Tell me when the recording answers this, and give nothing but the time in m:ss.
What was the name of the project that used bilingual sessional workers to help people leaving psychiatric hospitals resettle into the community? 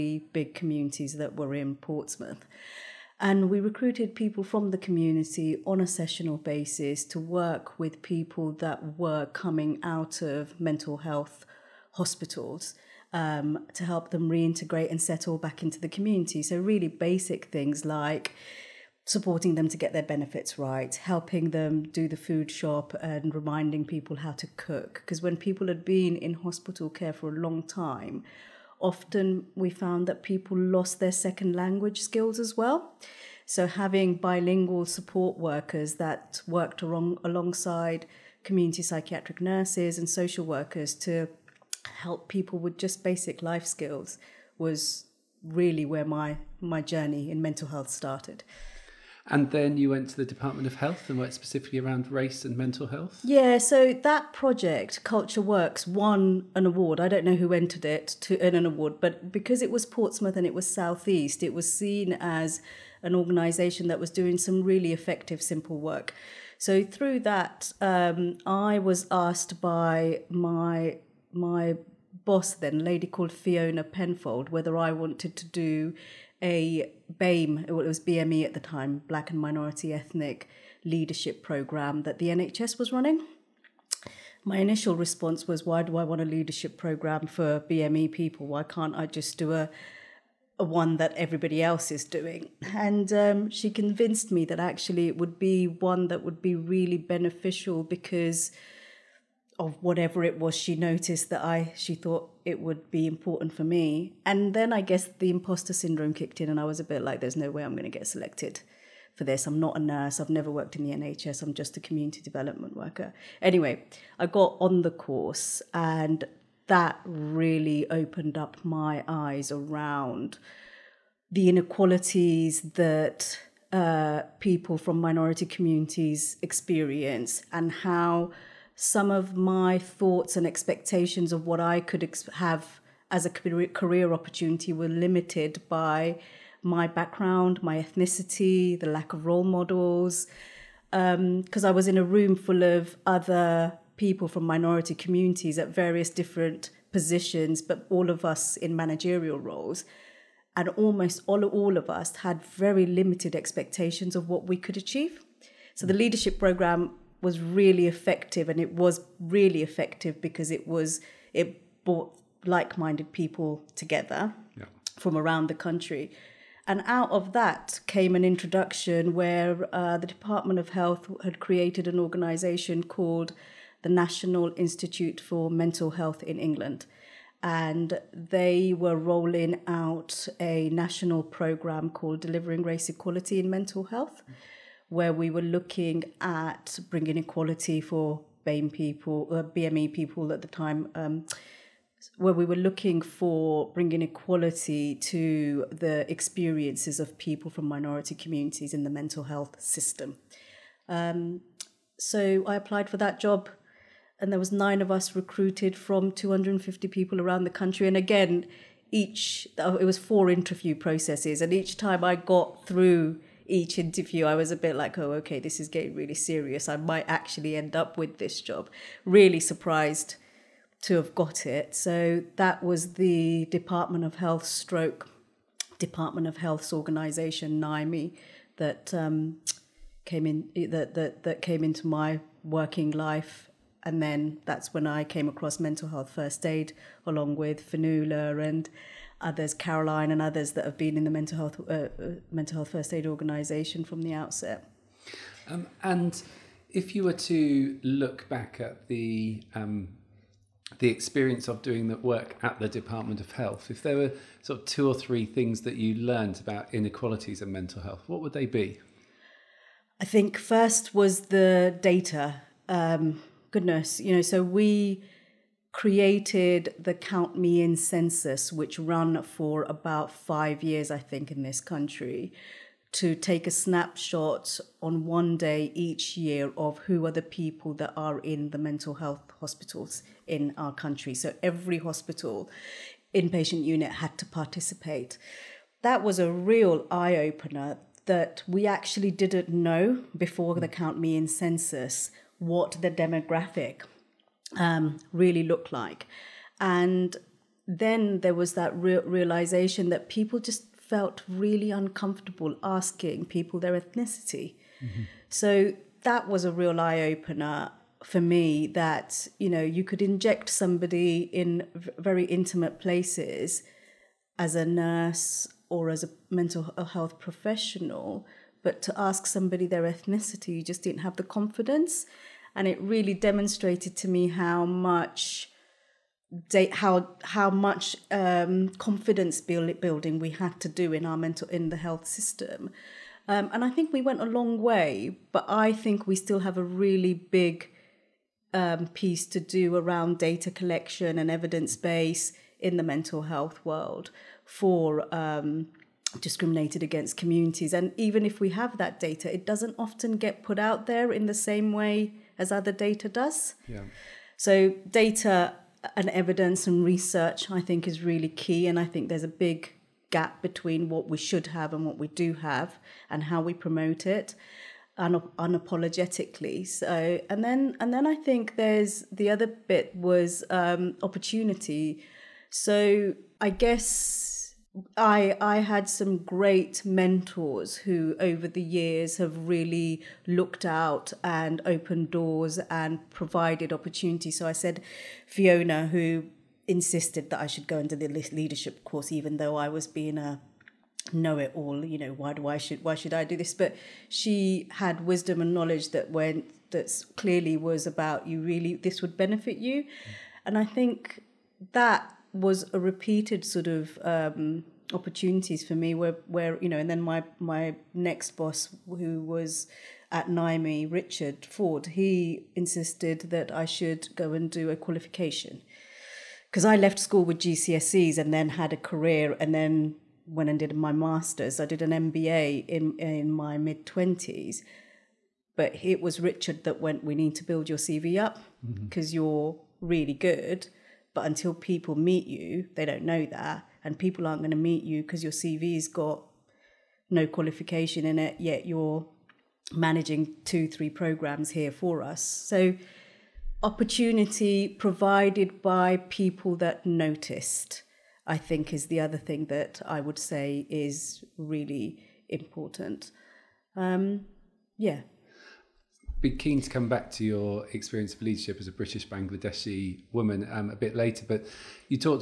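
0:55.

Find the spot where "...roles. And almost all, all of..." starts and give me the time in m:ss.
2:29.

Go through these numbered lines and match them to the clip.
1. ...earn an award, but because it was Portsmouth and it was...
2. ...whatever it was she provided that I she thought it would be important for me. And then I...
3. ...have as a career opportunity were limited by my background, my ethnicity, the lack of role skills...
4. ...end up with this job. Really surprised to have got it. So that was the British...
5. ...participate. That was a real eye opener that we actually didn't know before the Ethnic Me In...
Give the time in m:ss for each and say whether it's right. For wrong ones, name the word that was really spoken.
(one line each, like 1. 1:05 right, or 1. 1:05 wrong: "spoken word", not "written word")
1. 0:58 right
2. 1:39 wrong: "noticed", not "provided"
3. 2:12 wrong: "models", not "skills"
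4. 3:37 wrong: "Department", not "British"
5. 4:44 wrong: "Count", not "Ethnic".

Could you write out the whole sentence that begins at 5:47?
And even if we have that data, it doesn't often get put out there in the same way as other data does.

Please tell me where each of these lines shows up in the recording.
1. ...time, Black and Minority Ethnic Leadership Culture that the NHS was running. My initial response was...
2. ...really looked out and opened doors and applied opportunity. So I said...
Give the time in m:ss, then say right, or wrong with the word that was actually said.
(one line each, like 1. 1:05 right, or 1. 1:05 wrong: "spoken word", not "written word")
1. 1:18 wrong: "Program", not "Culture"
2. 6:19 wrong: "provided", not "applied".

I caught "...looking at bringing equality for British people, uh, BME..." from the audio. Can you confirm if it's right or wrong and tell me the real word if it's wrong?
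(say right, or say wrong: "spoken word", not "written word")
wrong: "BAME", not "British".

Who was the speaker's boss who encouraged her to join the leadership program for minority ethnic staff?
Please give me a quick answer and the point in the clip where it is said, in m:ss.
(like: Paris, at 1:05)
Fiona Penfold, at 1:13.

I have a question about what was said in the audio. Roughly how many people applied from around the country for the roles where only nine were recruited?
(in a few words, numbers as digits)
250.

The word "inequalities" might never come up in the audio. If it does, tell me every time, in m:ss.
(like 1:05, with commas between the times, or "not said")
2:01, 4:16.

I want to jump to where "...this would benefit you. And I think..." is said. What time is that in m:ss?
6:38.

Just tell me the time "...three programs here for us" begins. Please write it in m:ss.
7:20.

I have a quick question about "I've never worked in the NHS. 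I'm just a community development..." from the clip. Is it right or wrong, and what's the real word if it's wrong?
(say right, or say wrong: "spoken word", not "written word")
right.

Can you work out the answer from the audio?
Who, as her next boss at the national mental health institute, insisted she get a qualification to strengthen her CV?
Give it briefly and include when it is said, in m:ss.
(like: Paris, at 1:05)
Richard Ford, at 6:50.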